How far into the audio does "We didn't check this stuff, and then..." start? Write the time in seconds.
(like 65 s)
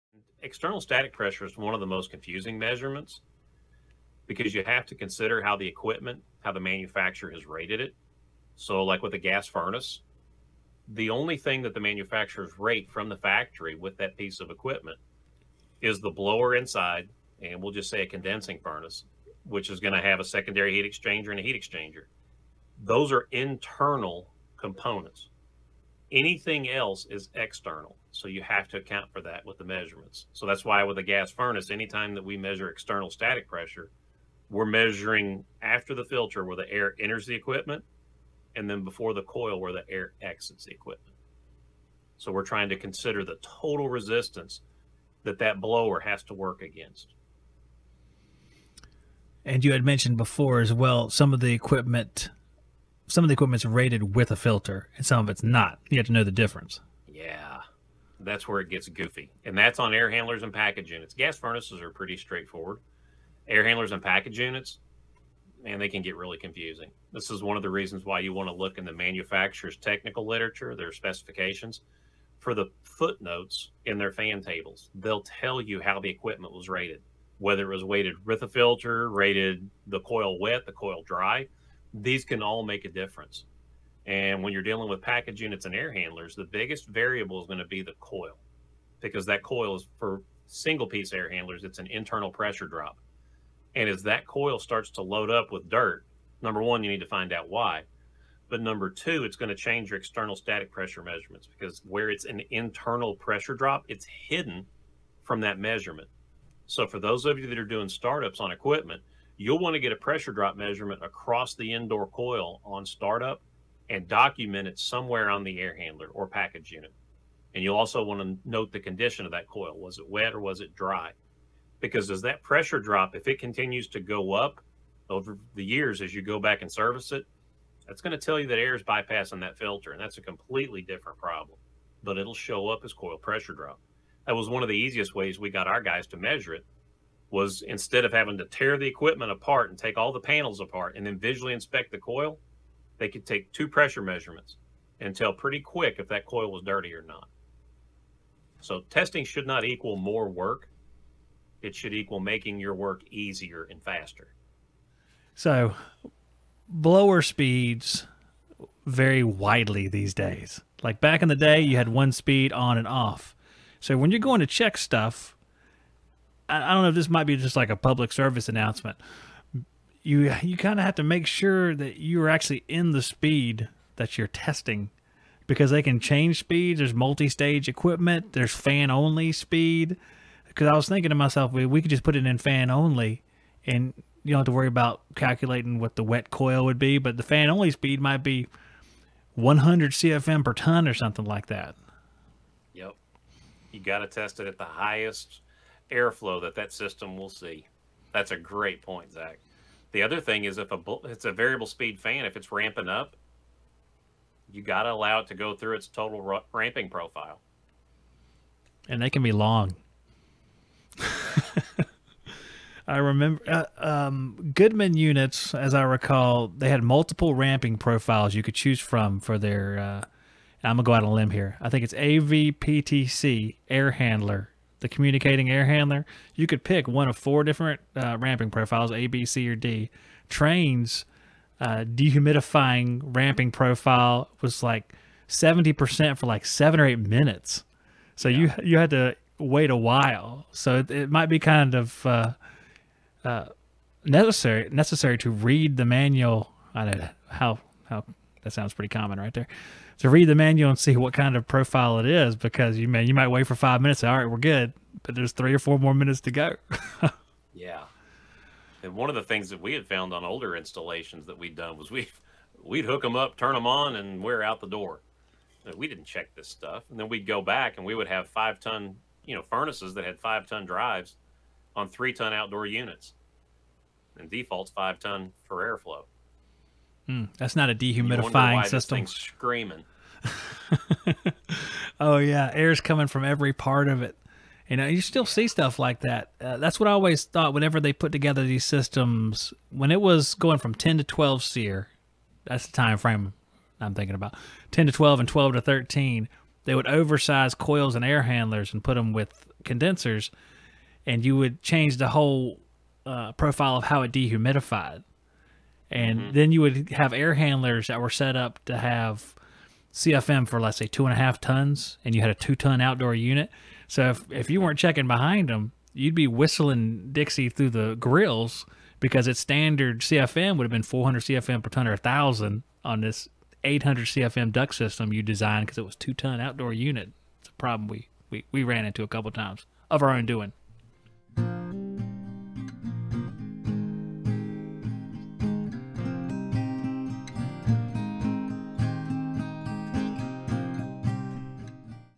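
265 s.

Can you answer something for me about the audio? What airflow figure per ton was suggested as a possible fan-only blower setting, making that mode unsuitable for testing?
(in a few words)
100 CFM per ton.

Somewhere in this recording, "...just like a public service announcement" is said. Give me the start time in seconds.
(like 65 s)
167 s.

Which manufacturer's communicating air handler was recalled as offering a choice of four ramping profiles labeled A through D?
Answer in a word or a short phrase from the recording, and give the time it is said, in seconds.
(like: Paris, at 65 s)
Goodman, at 214 s.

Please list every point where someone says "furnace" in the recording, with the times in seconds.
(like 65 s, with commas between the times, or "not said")
9 s, 18 s, 31 s, 61 s, 269 s.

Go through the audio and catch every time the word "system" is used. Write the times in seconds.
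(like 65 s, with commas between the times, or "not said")
196 s, 278 s, 288 s, 324 s.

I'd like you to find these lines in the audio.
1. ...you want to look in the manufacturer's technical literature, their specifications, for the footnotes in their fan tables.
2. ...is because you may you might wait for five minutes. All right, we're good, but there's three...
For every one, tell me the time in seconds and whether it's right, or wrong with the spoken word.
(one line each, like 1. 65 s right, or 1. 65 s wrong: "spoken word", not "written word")
1. 68 s right
2. 252 s right.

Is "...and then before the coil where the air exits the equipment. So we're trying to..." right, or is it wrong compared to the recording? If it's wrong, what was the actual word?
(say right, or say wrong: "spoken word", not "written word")
right.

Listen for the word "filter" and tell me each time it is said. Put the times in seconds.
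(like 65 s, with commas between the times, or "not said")
36 s, 54 s, 78 s, 129 s.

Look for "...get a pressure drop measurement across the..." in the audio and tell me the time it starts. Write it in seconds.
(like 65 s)
109 s.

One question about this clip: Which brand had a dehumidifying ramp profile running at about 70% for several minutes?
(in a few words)
Trane.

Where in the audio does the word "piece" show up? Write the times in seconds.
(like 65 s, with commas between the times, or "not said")
14 s, 90 s.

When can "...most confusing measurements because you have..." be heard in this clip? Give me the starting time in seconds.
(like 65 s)
1 s.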